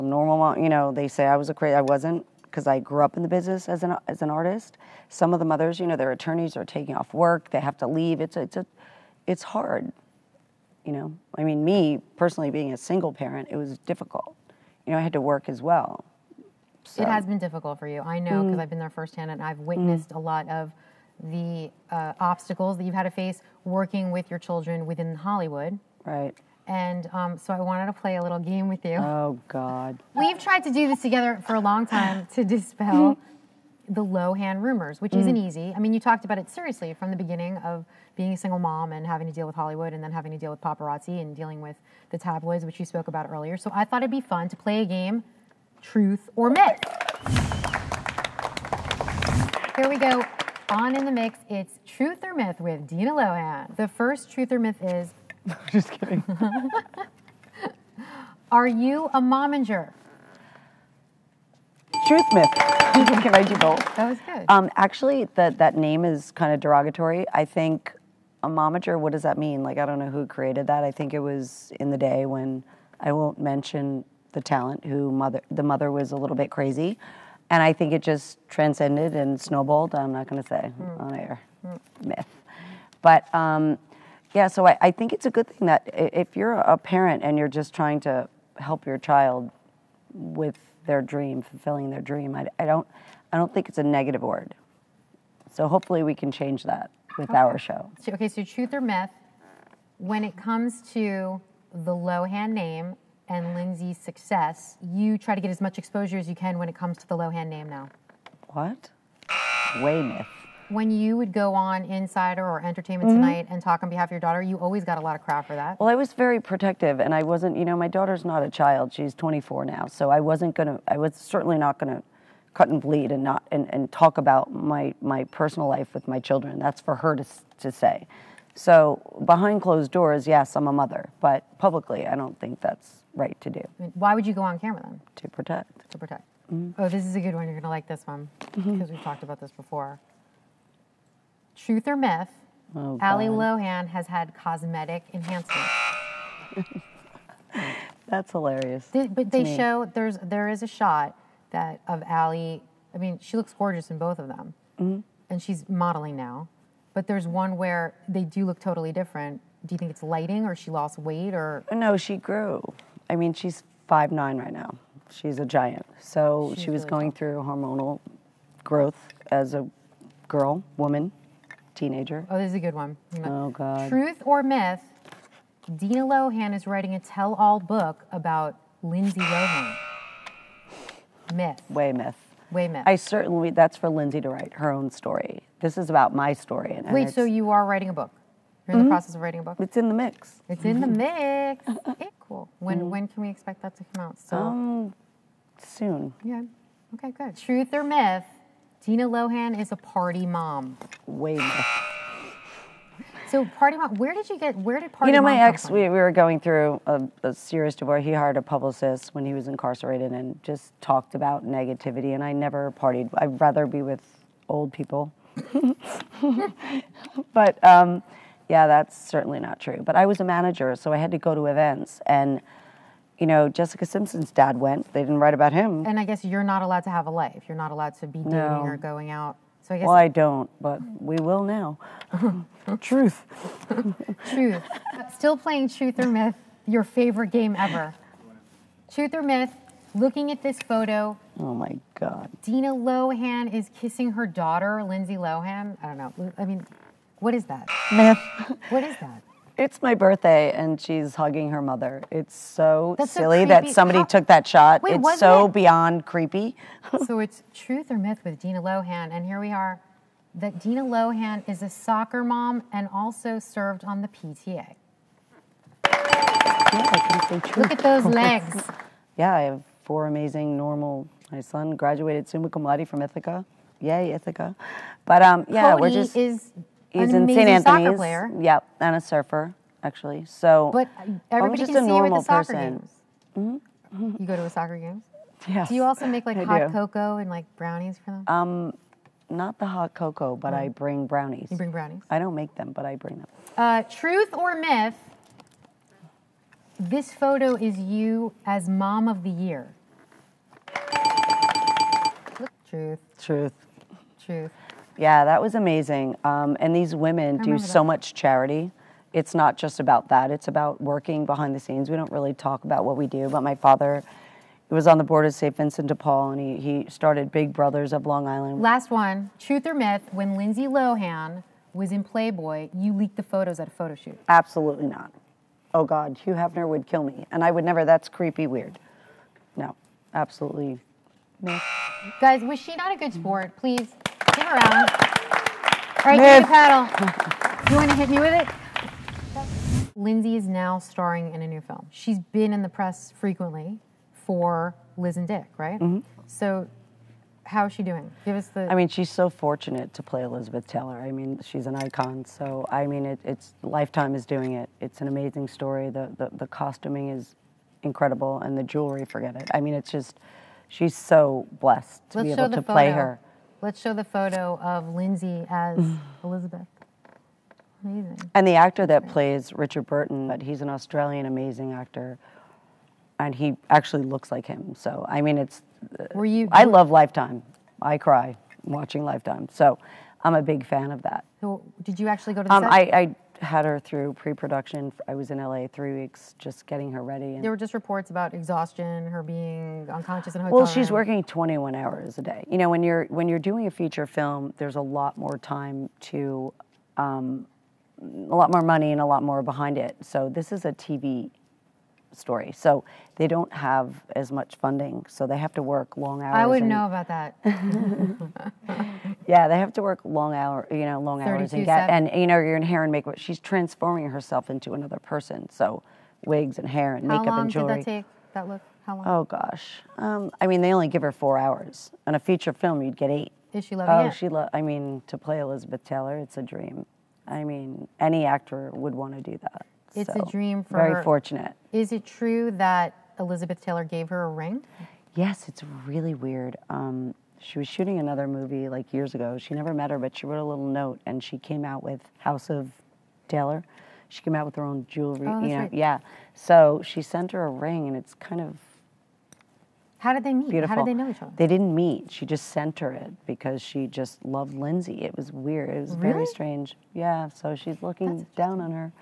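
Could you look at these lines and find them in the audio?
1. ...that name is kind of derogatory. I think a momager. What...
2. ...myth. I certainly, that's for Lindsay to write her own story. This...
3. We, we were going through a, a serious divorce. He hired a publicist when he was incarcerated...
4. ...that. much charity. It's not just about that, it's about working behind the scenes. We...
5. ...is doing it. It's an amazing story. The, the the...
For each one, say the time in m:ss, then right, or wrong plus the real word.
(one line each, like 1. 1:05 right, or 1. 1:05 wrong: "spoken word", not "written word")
1. 1:05 right
2. 3:02 right
3. 3:25 right
4. 5:07 right
5. 5:54 right.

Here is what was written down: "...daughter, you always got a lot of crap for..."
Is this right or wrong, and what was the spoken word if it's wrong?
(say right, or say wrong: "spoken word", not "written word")
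right.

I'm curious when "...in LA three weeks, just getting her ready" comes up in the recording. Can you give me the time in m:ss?
6:25.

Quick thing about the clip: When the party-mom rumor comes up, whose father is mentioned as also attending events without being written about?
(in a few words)
Jessica Simpson.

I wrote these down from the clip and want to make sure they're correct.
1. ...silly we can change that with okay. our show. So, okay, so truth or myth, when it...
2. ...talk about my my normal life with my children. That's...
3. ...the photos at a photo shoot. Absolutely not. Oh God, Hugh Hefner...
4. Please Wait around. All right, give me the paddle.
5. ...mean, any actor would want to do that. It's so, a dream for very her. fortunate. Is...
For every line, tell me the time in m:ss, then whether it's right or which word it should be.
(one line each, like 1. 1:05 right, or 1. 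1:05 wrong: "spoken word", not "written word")
1. 1:35 wrong: "hopefully", not "silly"
2. 2:03 wrong: "personal", not "normal"
3. 5:23 right
4. 5:33 wrong: "Right", not "Wait"
5. 7:07 right.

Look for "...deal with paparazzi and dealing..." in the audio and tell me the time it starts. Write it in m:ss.
0:40.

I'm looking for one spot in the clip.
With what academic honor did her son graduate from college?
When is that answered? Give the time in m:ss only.
4:32.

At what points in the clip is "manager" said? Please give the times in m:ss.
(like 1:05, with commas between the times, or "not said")
3:40.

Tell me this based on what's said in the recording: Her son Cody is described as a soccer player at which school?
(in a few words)
St. Anthony's.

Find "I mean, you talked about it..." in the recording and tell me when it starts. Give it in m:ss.
0:35.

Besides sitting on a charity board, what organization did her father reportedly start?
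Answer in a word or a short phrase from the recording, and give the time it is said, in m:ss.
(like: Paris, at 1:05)
Big Brothers of Long Island, at 5:17.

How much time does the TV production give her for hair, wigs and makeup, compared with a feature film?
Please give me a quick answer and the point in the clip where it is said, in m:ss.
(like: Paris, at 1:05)
4 hours, at 7:01.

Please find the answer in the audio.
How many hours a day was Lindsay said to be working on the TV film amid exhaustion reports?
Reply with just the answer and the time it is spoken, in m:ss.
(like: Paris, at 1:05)
21, at 6:31.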